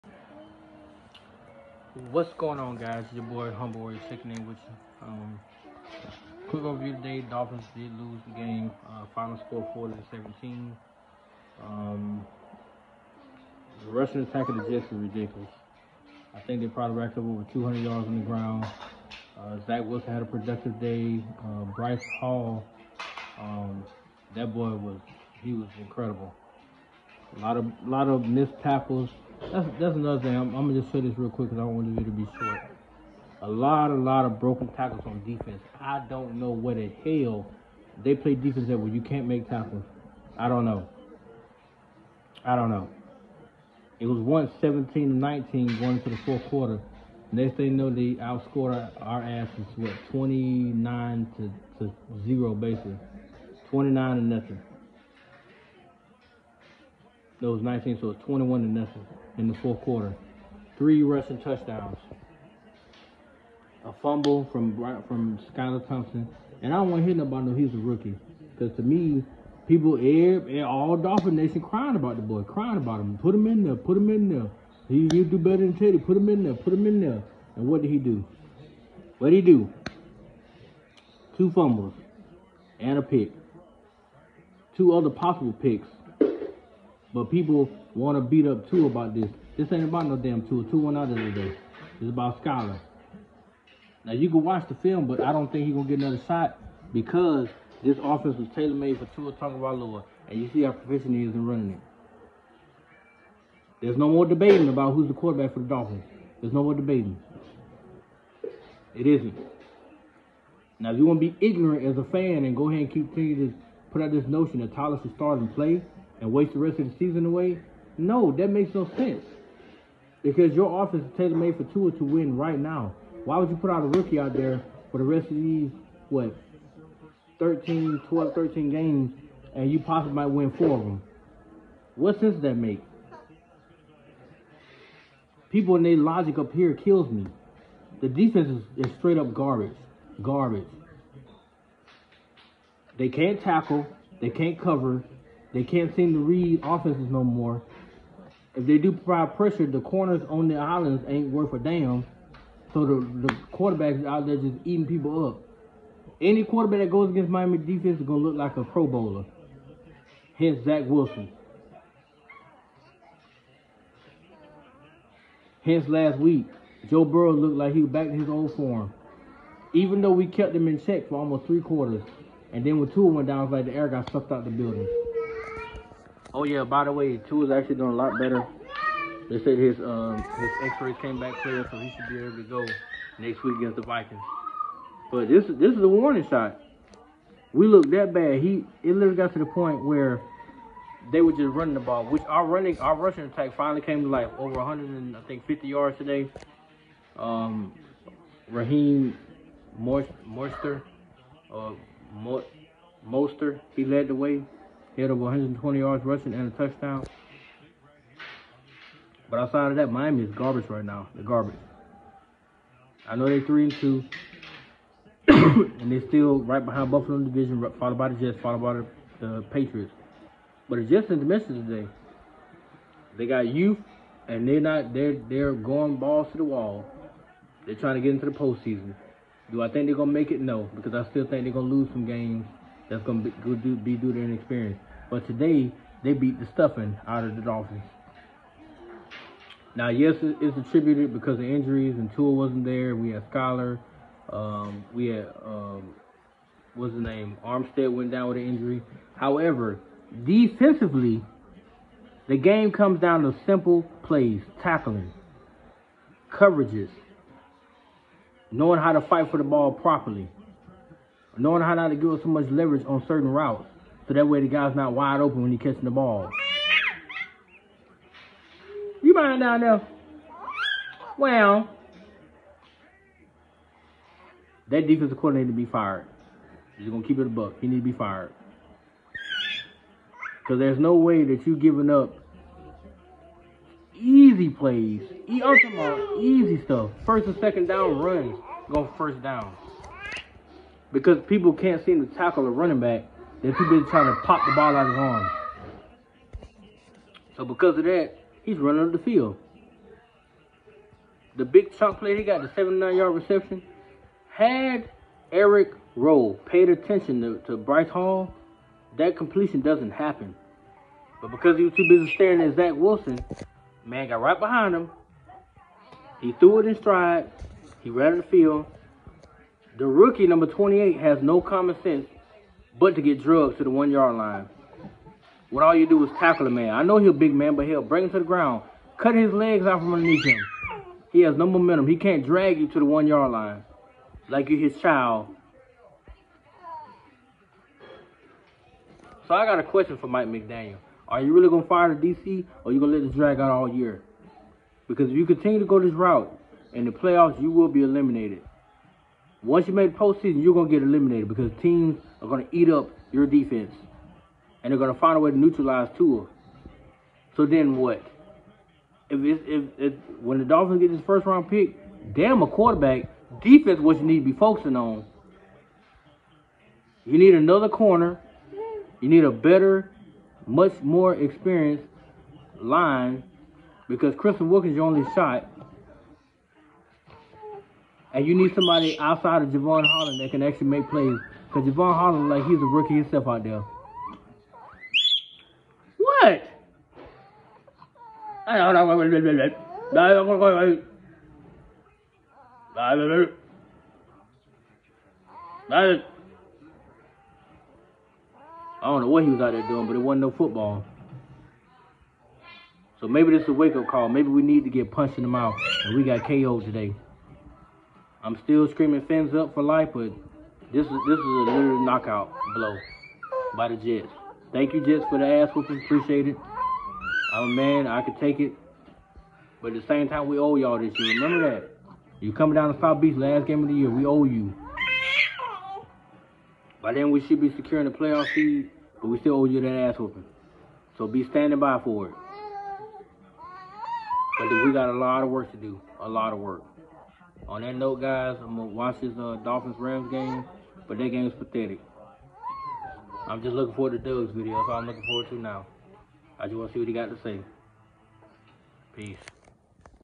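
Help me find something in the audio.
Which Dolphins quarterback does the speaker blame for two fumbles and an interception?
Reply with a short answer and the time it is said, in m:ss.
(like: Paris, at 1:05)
Skylar Thompson, at 1:05.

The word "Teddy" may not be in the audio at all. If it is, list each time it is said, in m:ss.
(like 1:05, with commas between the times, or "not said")
1:15.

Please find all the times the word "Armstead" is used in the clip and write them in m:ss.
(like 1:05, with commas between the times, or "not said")
4:07.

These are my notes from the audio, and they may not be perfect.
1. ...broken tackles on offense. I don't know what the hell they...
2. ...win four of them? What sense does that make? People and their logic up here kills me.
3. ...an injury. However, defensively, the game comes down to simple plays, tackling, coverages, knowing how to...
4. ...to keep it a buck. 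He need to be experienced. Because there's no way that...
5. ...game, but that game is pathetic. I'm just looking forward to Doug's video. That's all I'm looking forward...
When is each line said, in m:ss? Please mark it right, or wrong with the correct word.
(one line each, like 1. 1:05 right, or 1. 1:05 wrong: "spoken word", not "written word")
1. 0:34 wrong: "defense", not "offense"
2. 2:10 right
3. 4:08 right
4. 4:37 wrong: "fired", not "experienced"
5. 7:20 right.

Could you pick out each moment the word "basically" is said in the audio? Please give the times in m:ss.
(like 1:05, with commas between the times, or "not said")
0:52.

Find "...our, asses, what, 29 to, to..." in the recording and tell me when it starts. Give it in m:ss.
0:49.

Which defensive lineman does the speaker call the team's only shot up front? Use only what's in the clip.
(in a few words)
Christian Wilkins.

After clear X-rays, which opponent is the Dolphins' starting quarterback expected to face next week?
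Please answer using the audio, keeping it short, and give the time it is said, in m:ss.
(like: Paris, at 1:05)
the Vikings, at 3:03.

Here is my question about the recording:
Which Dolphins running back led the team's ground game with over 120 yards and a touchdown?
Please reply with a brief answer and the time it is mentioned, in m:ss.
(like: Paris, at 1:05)
Raheem Mostert, at 3:18.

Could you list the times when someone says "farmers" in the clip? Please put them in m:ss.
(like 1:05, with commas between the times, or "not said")
not said.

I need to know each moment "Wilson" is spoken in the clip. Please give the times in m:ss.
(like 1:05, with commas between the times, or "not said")
0:19, 2:40, 5:12.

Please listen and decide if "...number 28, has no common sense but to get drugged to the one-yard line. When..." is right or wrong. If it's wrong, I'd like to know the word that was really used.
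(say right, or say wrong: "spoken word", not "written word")
right.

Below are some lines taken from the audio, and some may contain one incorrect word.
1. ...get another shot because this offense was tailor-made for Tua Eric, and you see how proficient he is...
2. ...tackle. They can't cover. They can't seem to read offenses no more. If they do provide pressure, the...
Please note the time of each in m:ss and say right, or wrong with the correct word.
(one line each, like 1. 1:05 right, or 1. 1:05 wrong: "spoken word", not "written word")
1. 1:35 wrong: "Tagovailoa", not "Eric"
2. 2:23 right.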